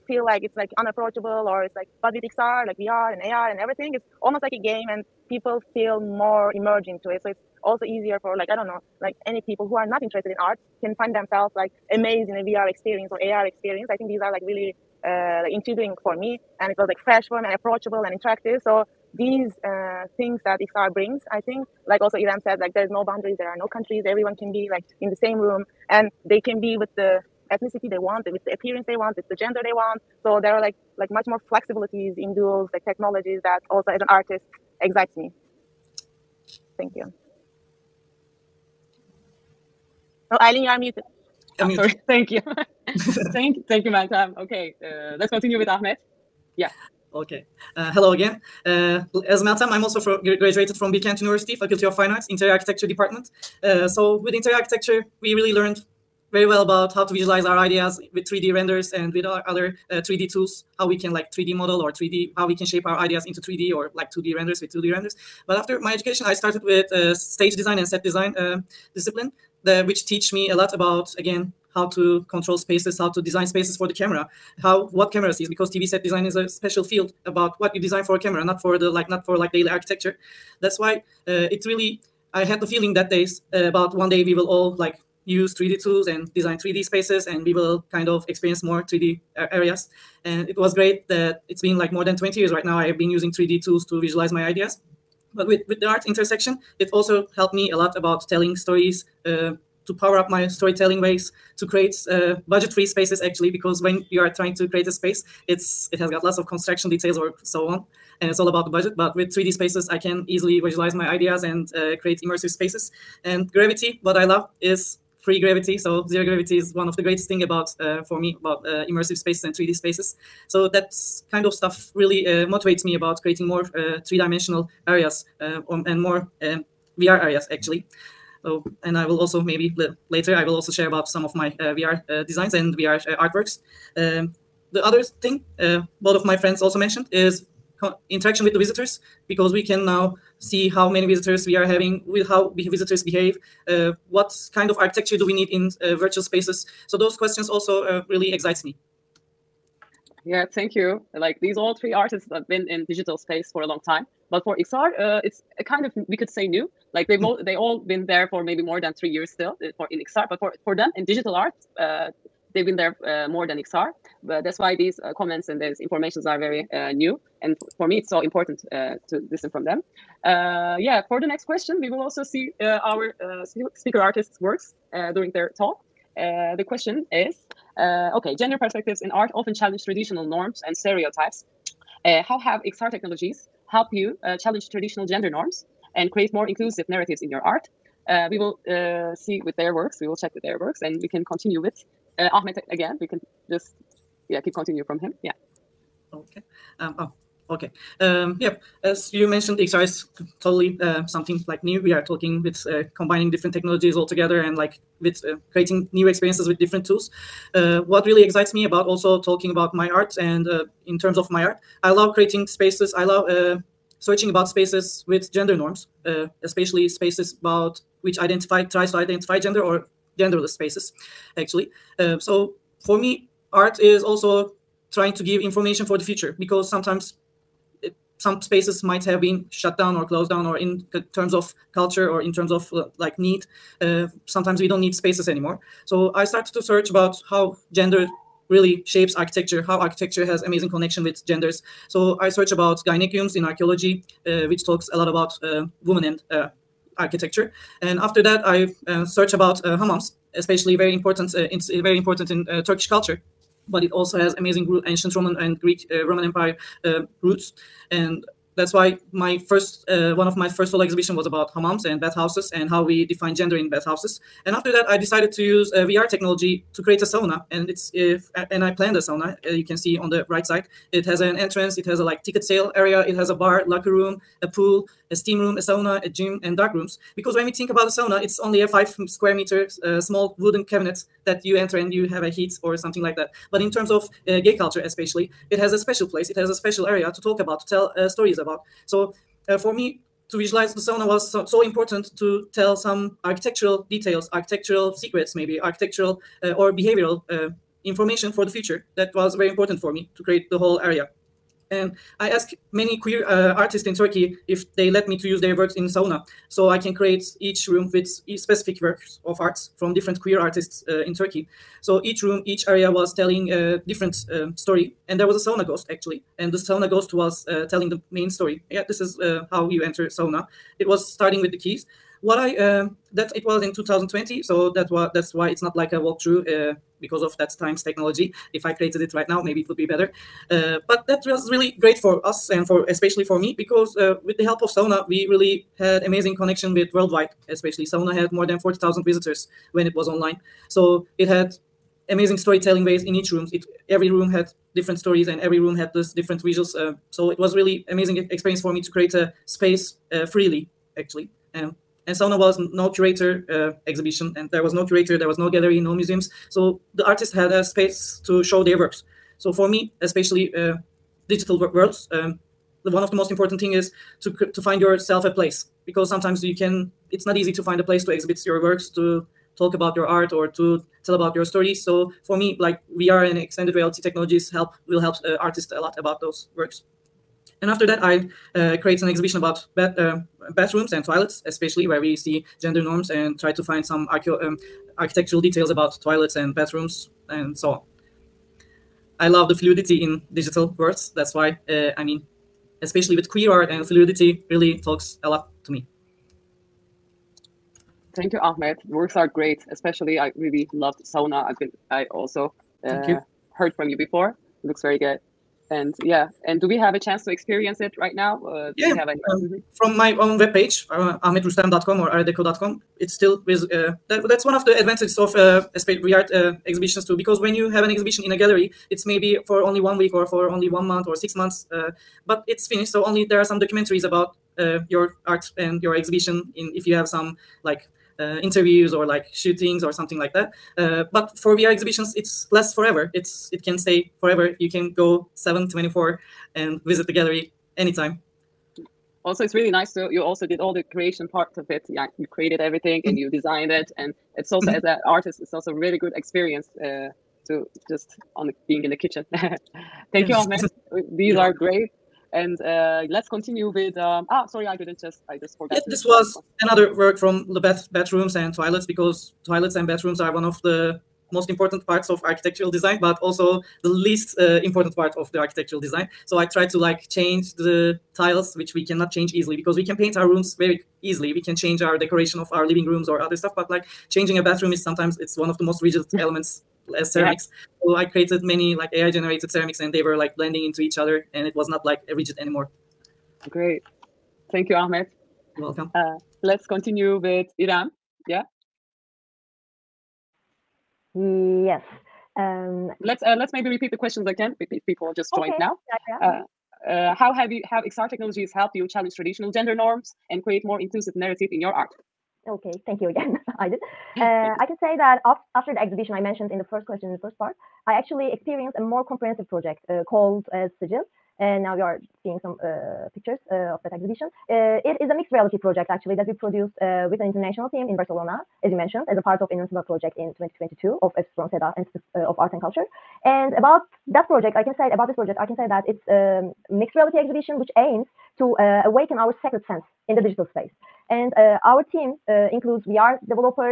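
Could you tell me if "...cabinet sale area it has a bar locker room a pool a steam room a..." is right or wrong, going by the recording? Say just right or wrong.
wrong.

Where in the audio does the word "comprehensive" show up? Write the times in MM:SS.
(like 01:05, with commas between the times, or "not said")
08:29.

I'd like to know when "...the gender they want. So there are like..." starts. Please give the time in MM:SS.
00:29.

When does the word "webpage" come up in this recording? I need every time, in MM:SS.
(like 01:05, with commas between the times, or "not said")
06:50.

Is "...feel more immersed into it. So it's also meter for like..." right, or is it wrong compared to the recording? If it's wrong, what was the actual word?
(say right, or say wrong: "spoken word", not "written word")
wrong: "easier", not "meter".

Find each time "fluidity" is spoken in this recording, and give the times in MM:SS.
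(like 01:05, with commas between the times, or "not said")
06:29, 06:33.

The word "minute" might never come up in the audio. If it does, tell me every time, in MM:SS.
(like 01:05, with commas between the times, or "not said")
not said.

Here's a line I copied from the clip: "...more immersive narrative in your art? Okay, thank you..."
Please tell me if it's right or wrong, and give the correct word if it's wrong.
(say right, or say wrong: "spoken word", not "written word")
wrong: "inclusive", not "immersive".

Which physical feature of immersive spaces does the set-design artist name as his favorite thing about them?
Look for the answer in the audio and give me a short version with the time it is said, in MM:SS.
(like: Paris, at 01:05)
Zero gravity, at 01:56.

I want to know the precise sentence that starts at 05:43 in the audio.
It every room had different stories and every room had this different visuals.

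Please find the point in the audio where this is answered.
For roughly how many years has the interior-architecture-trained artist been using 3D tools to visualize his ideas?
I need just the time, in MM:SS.
01:31.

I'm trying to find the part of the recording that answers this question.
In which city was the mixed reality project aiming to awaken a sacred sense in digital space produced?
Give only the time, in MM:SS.
08:37.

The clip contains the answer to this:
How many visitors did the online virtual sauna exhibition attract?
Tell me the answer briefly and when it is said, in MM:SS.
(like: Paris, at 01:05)
More than 40,000, at 05:38.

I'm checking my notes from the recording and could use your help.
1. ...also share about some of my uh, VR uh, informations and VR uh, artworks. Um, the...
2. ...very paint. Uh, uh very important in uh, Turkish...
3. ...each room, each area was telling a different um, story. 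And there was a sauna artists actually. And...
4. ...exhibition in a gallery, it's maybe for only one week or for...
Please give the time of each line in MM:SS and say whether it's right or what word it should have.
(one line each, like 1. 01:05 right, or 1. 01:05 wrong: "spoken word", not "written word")
1. 02:10 wrong: "designs", not "informations"
2. 04:10 wrong: "important", not "paint"
3. 05:12 wrong: "ghost", not "artists"
4. 06:57 right.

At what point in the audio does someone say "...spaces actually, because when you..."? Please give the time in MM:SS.
01:42.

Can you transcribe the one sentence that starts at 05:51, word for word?
Um, and sauna was no curator uh, exhibition, and there was no curator, there was no gallery, no museums.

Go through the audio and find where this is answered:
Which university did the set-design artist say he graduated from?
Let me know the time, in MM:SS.
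00:50.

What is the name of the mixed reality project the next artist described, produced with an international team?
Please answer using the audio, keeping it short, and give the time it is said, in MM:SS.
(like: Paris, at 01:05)
Sigil, at 08:30.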